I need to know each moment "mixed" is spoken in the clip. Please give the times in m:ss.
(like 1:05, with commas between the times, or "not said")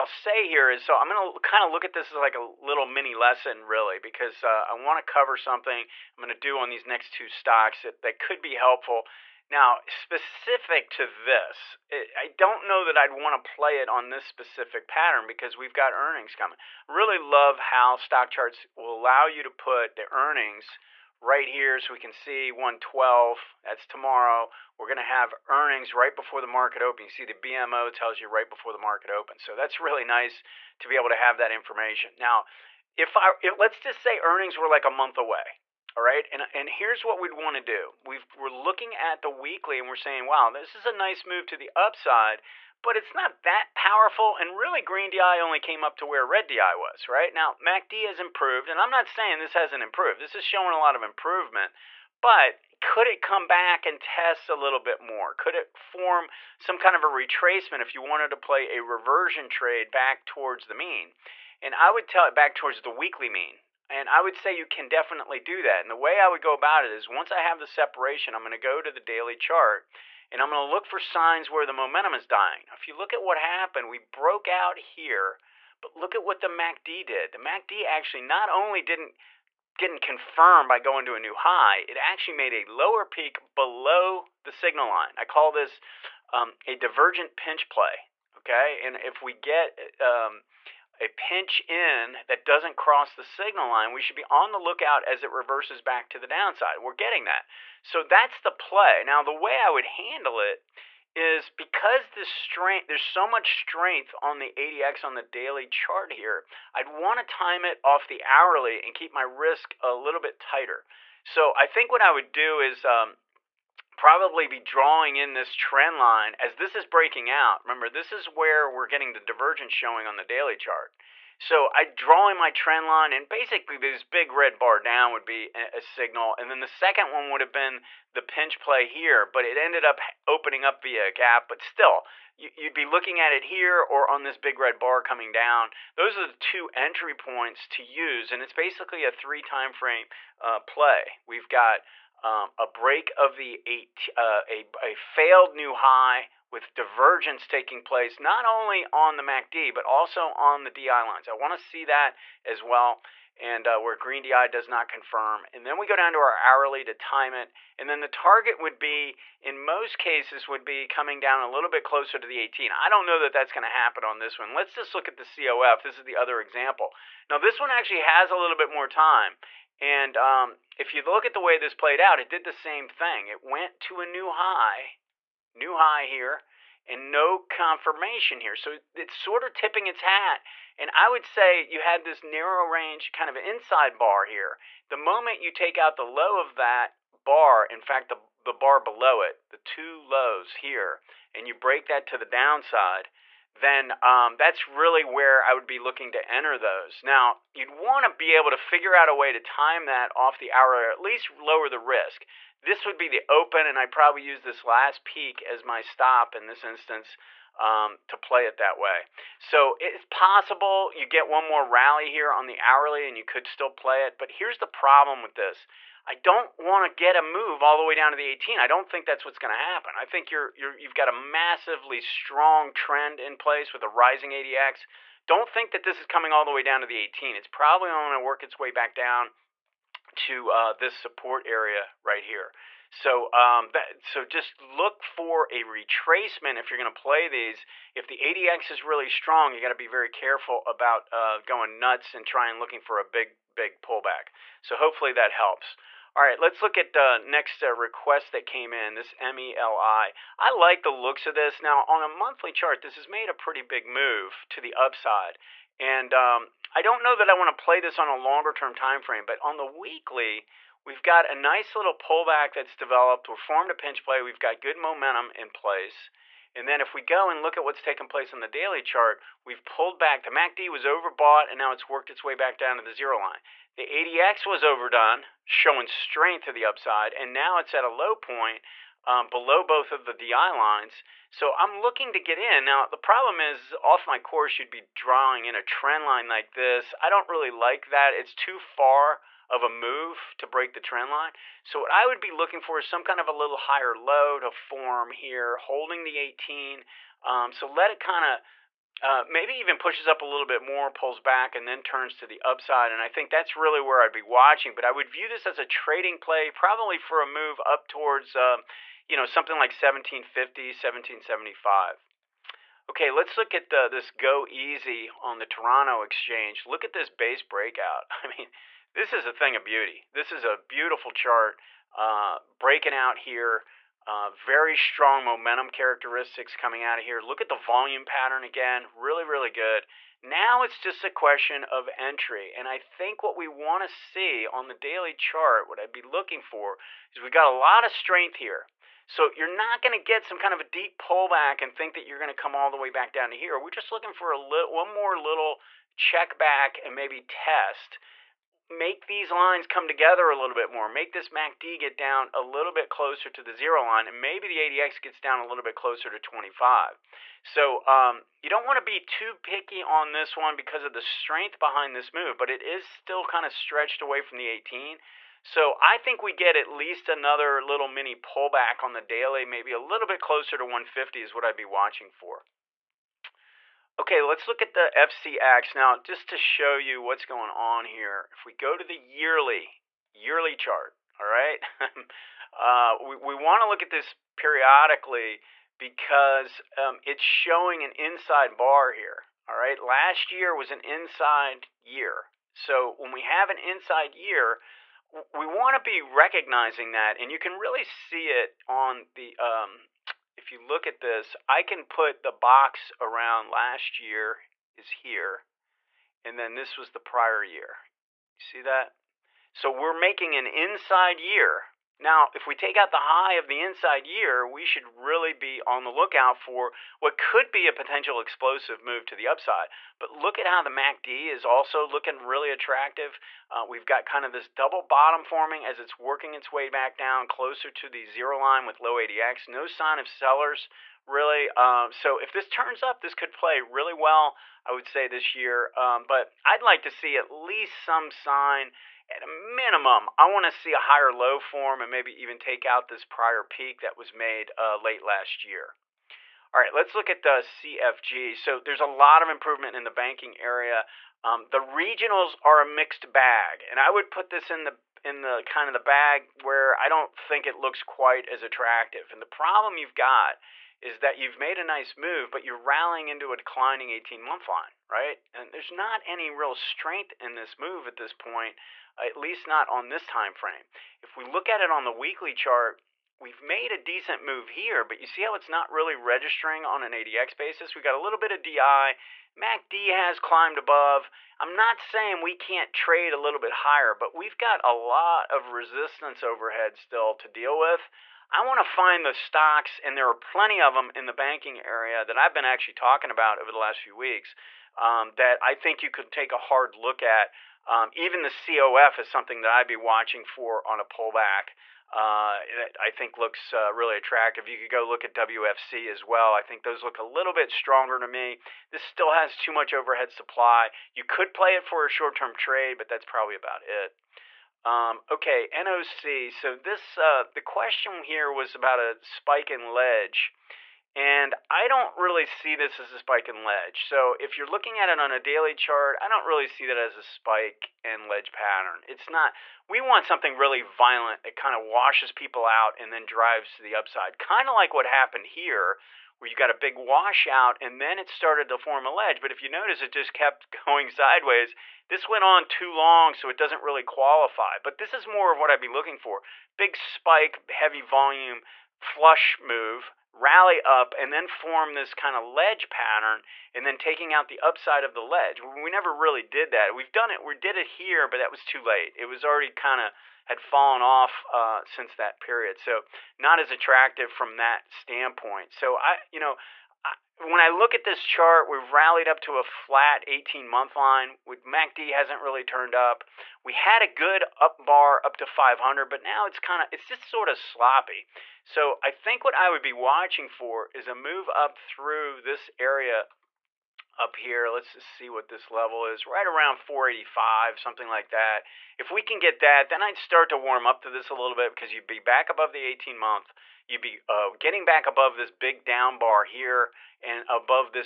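7:32.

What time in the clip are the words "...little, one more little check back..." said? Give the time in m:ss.
5:44.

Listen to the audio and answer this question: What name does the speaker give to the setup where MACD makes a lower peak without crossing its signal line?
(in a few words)
divergent pinch play.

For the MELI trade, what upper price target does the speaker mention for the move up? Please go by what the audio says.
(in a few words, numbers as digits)
1775.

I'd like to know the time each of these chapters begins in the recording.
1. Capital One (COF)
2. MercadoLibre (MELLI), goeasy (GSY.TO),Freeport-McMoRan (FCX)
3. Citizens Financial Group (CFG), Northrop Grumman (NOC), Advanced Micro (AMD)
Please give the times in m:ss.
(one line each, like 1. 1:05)
1. 2:45
2. 4:05
3. 7:26.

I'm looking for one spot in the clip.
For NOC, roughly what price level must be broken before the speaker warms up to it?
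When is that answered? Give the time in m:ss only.
9:46.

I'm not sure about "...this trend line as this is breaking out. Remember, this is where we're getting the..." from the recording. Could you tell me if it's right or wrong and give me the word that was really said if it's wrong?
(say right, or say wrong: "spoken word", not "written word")
right.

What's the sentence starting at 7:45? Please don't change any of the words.
And there's not any real strength in this move at this point at least not on this time frame.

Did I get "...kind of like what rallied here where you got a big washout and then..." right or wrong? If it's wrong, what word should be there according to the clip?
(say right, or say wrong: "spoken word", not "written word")
wrong: "happened", not "rallied".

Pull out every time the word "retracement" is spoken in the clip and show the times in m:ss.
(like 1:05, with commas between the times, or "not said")
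0:57, 3:55.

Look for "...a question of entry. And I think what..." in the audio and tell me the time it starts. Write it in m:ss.
5:31.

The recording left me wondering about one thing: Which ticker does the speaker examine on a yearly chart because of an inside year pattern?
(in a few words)
FCX.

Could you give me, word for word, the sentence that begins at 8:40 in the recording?
And I don't really see this as a spike and ledge.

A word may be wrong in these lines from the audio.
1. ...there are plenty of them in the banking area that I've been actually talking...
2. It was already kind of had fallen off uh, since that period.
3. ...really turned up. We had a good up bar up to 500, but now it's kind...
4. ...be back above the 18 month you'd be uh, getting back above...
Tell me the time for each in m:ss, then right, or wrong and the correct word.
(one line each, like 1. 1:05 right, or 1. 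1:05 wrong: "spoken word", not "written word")
1. 8:09 right
2. 9:18 right
3. 9:32 right
4. 9:51 right.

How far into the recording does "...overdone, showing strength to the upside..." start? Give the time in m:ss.
4:34.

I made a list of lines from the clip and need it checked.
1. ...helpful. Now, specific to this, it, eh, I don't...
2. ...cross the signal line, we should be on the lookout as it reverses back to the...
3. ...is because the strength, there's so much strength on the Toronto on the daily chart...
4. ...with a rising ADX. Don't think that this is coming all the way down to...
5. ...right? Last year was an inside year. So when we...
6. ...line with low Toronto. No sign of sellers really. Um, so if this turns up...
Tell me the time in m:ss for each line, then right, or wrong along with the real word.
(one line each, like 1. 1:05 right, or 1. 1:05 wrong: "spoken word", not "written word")
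1. 0:08 right
2. 1:32 right
3. 1:41 wrong: "ADX", not "Toronto"
4. 3:43 right
5. 6:29 right
6. 7:08 wrong: "ADX", not "Toronto".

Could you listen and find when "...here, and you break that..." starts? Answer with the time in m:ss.
3:10.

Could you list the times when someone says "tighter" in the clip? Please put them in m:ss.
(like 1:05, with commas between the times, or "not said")
1:50.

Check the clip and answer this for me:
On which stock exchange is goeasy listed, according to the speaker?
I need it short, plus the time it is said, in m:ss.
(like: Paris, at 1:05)
Toronto, at 5:15.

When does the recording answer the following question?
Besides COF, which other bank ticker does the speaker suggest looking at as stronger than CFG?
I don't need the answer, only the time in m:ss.
8:25.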